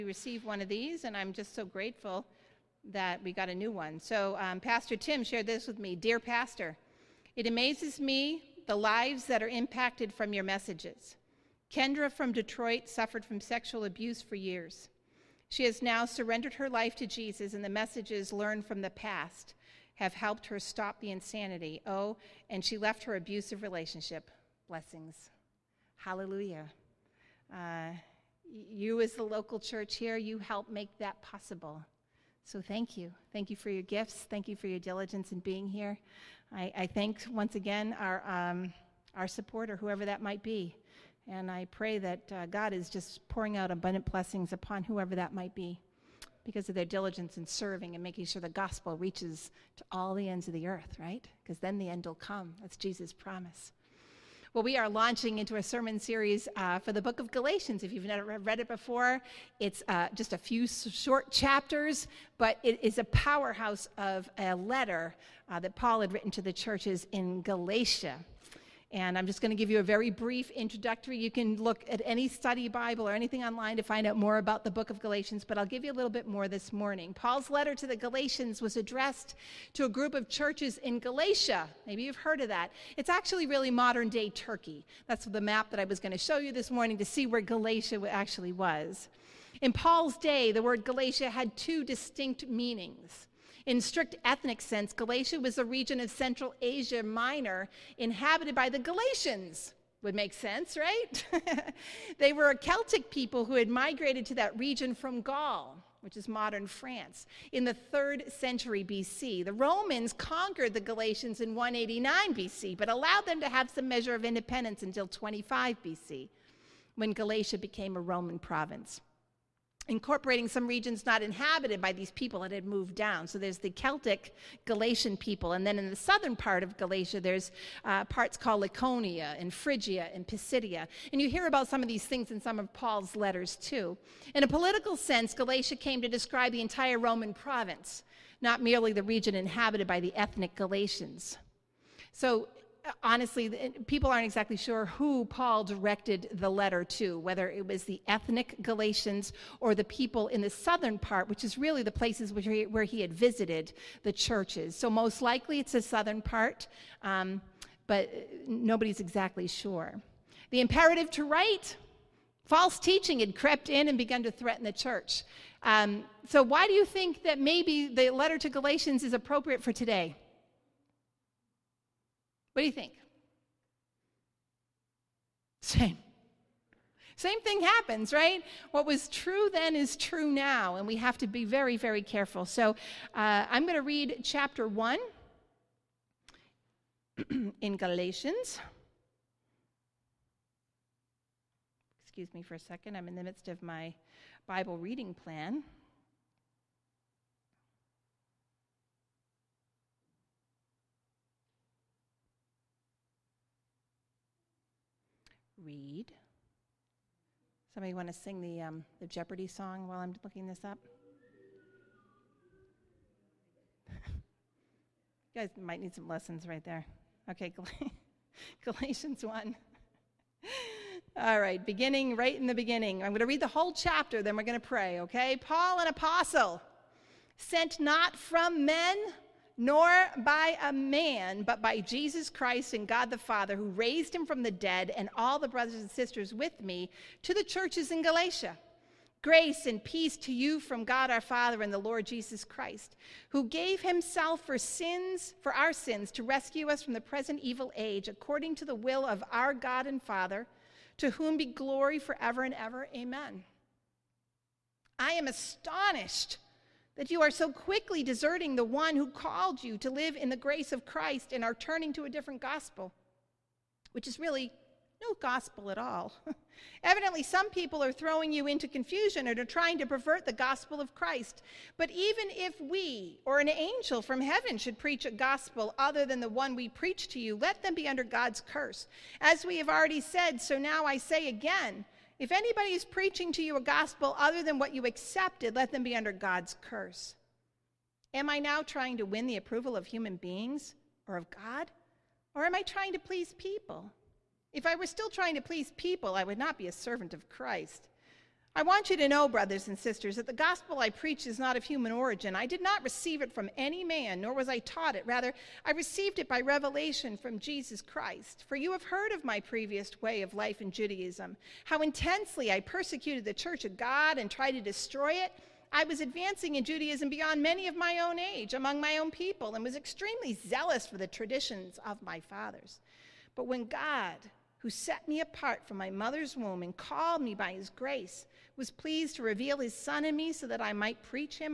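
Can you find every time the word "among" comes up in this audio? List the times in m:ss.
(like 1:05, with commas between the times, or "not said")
5:18.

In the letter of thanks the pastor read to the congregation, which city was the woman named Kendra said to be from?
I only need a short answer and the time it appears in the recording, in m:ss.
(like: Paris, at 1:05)
Detroit, at 0:12.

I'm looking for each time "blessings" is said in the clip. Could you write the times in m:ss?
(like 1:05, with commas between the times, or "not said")
0:24, 0:44.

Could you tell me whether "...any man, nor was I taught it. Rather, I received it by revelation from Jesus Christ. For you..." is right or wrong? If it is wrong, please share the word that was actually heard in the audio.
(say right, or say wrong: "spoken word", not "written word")
right.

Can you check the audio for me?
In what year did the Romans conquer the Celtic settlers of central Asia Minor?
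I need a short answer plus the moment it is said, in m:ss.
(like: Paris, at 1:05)
189 BC, at 1:51.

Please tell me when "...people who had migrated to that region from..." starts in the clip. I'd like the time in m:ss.
1:43.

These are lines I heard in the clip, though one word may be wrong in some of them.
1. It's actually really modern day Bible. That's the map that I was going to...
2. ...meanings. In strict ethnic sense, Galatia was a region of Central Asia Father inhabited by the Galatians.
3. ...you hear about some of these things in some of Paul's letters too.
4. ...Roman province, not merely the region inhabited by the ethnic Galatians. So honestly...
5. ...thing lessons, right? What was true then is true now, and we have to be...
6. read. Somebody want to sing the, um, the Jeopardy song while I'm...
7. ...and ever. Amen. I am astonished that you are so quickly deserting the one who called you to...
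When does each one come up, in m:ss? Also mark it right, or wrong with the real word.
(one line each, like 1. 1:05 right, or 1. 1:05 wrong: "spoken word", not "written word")
1. 1:22 wrong: "Turkey", not "Bible"
2. 1:32 wrong: "Minor", not "Father"
3. 2:11 right
4. 2:16 right
5. 2:57 wrong: "happens", not "lessons"
6. 3:25 right
7. 4:12 right.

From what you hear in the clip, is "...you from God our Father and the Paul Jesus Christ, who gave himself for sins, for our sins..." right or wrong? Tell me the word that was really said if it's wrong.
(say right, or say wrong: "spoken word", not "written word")
wrong: "Lord", not "Paul".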